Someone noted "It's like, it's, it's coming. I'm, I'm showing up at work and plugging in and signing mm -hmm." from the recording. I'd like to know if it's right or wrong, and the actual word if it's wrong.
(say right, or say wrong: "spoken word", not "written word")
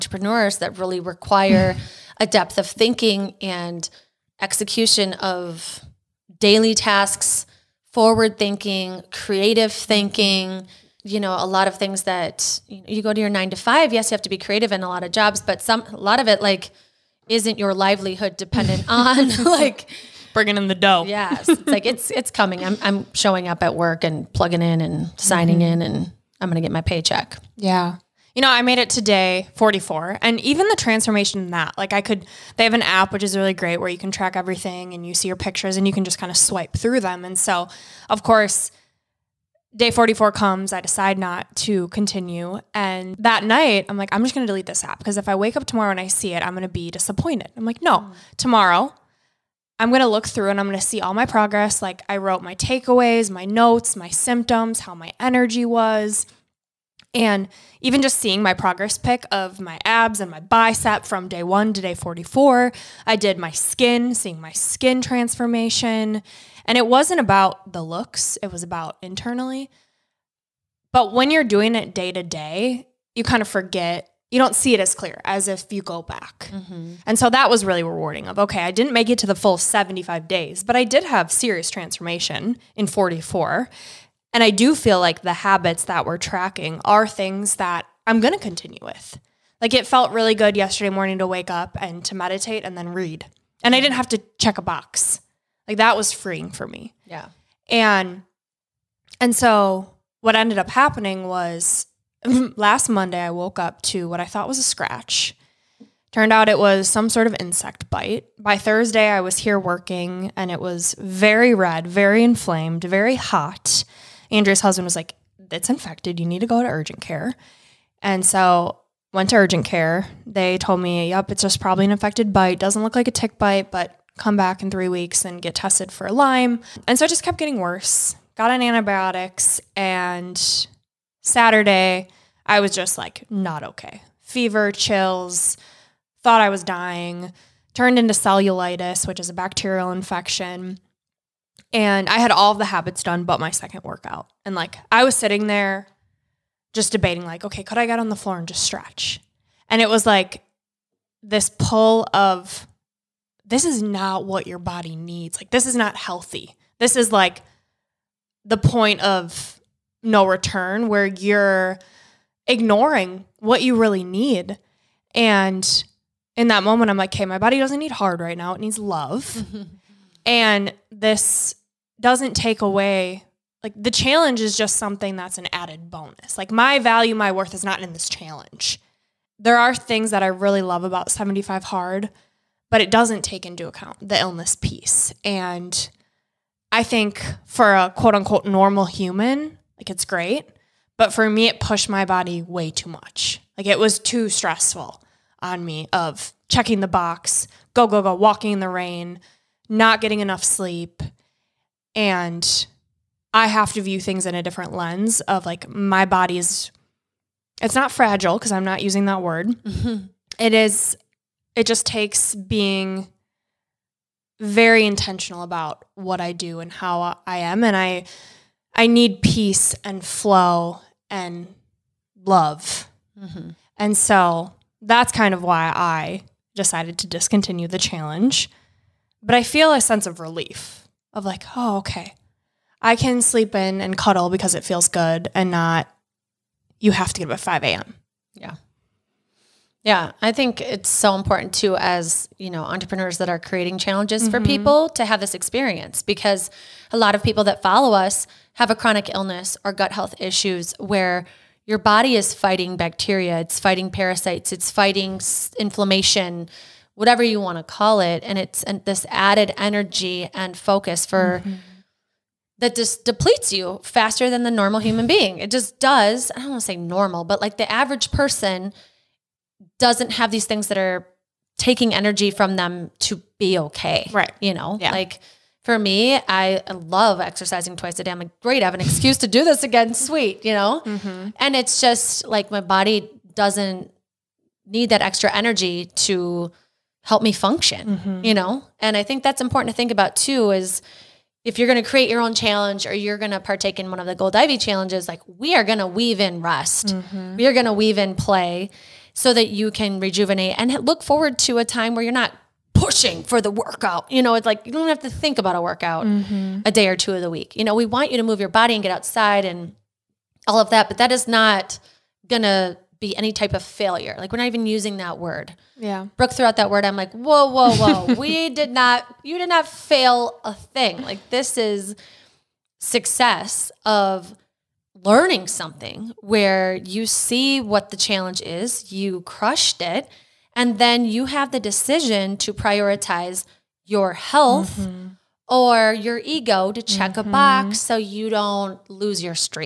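right.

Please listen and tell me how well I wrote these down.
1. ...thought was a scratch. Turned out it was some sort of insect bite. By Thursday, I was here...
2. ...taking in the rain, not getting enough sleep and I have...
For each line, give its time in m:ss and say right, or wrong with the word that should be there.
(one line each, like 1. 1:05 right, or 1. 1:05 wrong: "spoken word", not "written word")
1. 1:44 right
2. 3:18 wrong: "walking", not "taking".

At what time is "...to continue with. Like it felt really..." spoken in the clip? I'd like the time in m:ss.
1:28.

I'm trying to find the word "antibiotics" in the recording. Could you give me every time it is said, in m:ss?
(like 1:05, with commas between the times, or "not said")
2:08.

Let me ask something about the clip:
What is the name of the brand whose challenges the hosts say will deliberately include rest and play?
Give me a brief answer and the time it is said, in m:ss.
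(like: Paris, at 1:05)
Gold Ivy, at 4:54.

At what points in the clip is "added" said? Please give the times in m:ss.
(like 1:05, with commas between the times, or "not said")
2:55, 4:19.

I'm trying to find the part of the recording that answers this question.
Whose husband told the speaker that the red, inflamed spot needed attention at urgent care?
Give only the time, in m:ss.
1:54.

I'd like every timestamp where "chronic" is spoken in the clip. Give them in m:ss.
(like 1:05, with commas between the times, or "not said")
4:08.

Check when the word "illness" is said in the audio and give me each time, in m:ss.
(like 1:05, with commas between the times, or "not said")
3:04, 4:09.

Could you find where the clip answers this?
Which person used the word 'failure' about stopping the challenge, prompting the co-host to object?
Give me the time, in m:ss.
5:16.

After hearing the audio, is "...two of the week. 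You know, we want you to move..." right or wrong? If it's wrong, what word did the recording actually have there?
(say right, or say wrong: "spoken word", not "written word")
right.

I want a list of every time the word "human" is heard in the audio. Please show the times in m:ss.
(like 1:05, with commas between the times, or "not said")
3:08, 4:24.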